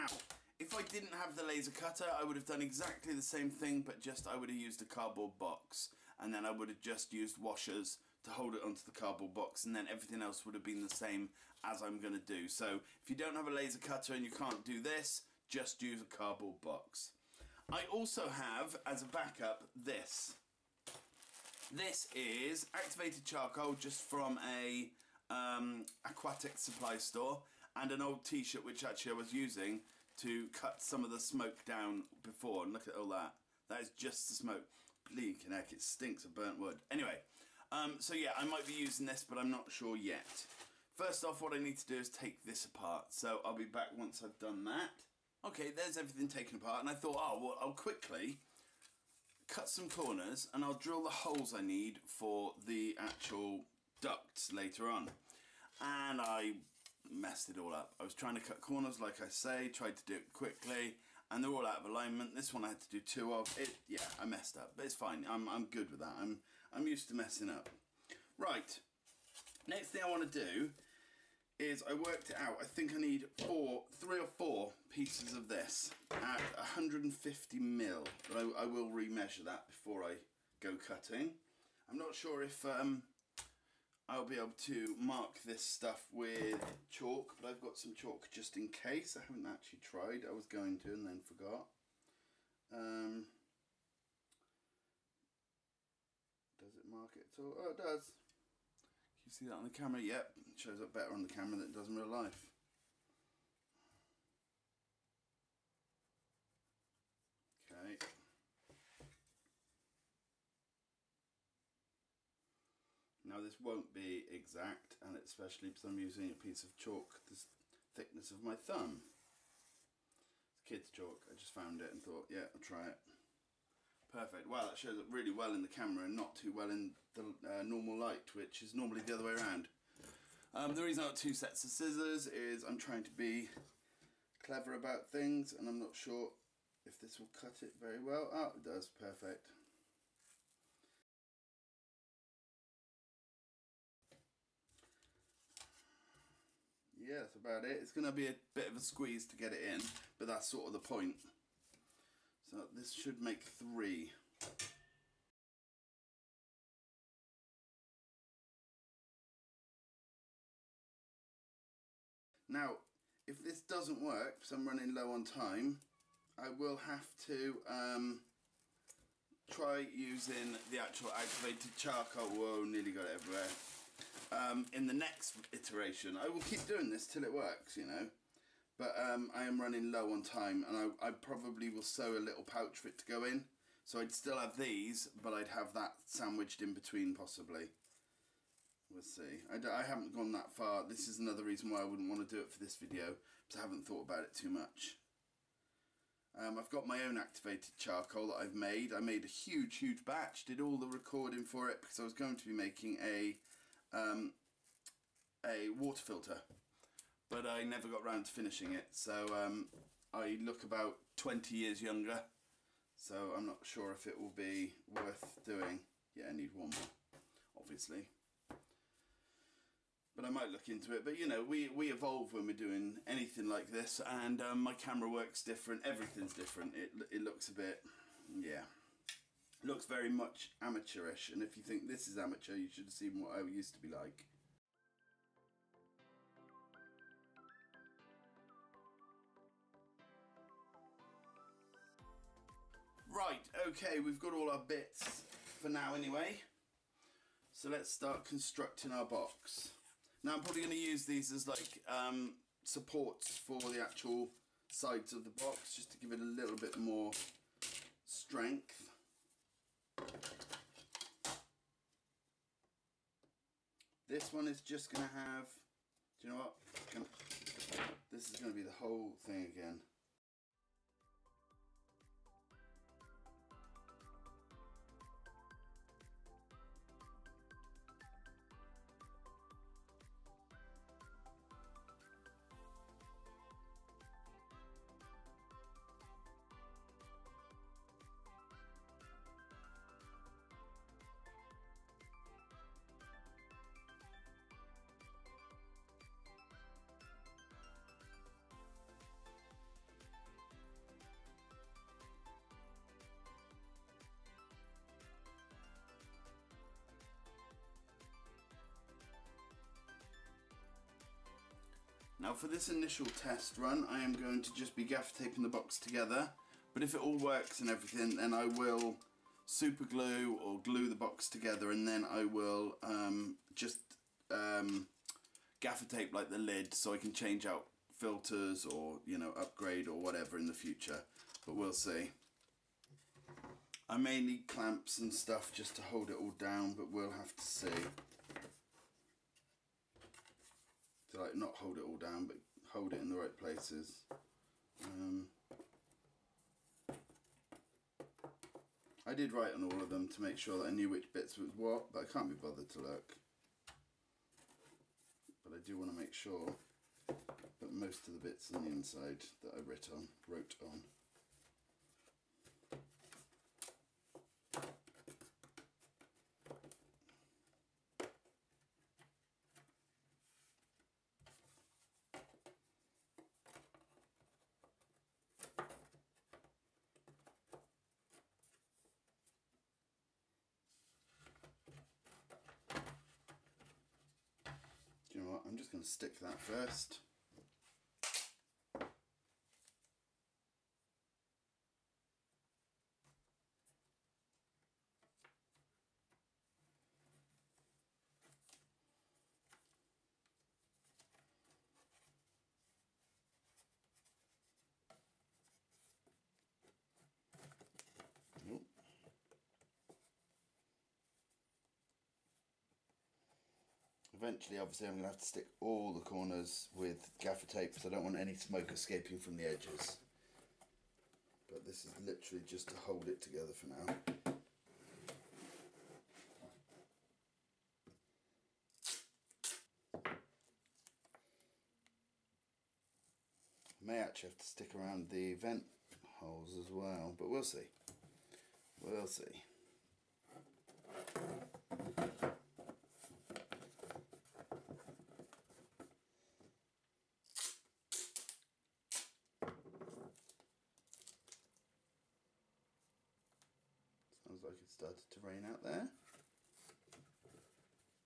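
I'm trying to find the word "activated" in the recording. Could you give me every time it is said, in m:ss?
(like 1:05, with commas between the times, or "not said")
0:22, 2:51, 3:17.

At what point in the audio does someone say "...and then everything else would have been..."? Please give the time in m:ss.
0:09.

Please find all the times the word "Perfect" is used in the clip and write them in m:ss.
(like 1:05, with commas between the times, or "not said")
2:04, 2:18.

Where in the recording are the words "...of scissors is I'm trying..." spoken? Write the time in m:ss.
2:11.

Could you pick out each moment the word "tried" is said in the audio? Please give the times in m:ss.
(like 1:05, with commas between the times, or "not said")
0:59, 1:29.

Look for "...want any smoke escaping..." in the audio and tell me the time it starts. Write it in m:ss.
6:58.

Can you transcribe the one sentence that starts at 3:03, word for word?
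So I'd still have these, but I'd have that sandwiched in between possibly.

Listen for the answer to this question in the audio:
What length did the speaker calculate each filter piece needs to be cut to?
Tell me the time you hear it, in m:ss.
1:16.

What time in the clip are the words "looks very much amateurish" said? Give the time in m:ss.
3:49.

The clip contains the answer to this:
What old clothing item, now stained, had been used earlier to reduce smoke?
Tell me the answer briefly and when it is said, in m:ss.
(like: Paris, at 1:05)
old t-shirt, at 0:28.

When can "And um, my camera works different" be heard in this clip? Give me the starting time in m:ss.
3:44.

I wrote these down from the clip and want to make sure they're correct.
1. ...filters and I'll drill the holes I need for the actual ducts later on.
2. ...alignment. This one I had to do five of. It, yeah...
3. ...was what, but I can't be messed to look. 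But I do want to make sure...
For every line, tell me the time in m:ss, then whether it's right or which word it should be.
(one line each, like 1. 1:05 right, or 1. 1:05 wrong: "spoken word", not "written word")
1. 0:49 wrong: "corners", not "filters"
2. 1:01 wrong: "two", not "five"
3. 5:51 wrong: "bothered", not "messed".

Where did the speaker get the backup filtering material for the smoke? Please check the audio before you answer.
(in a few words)
aquatic supply store.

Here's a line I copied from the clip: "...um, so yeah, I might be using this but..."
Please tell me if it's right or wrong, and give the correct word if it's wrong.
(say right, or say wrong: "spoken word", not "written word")
right.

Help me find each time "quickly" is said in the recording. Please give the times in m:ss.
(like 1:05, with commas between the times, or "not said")
0:47, 1:00.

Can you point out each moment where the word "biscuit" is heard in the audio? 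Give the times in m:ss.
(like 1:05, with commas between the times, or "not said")
not said.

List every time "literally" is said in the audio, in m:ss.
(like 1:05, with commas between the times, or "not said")
7:02.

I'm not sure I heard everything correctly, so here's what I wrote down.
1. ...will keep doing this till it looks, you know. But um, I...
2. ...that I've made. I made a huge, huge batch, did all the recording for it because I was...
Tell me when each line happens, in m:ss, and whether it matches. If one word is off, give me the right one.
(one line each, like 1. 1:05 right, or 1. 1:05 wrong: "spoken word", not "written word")
1. 2:56 wrong: "works", not "looks"
2. 3:18 right.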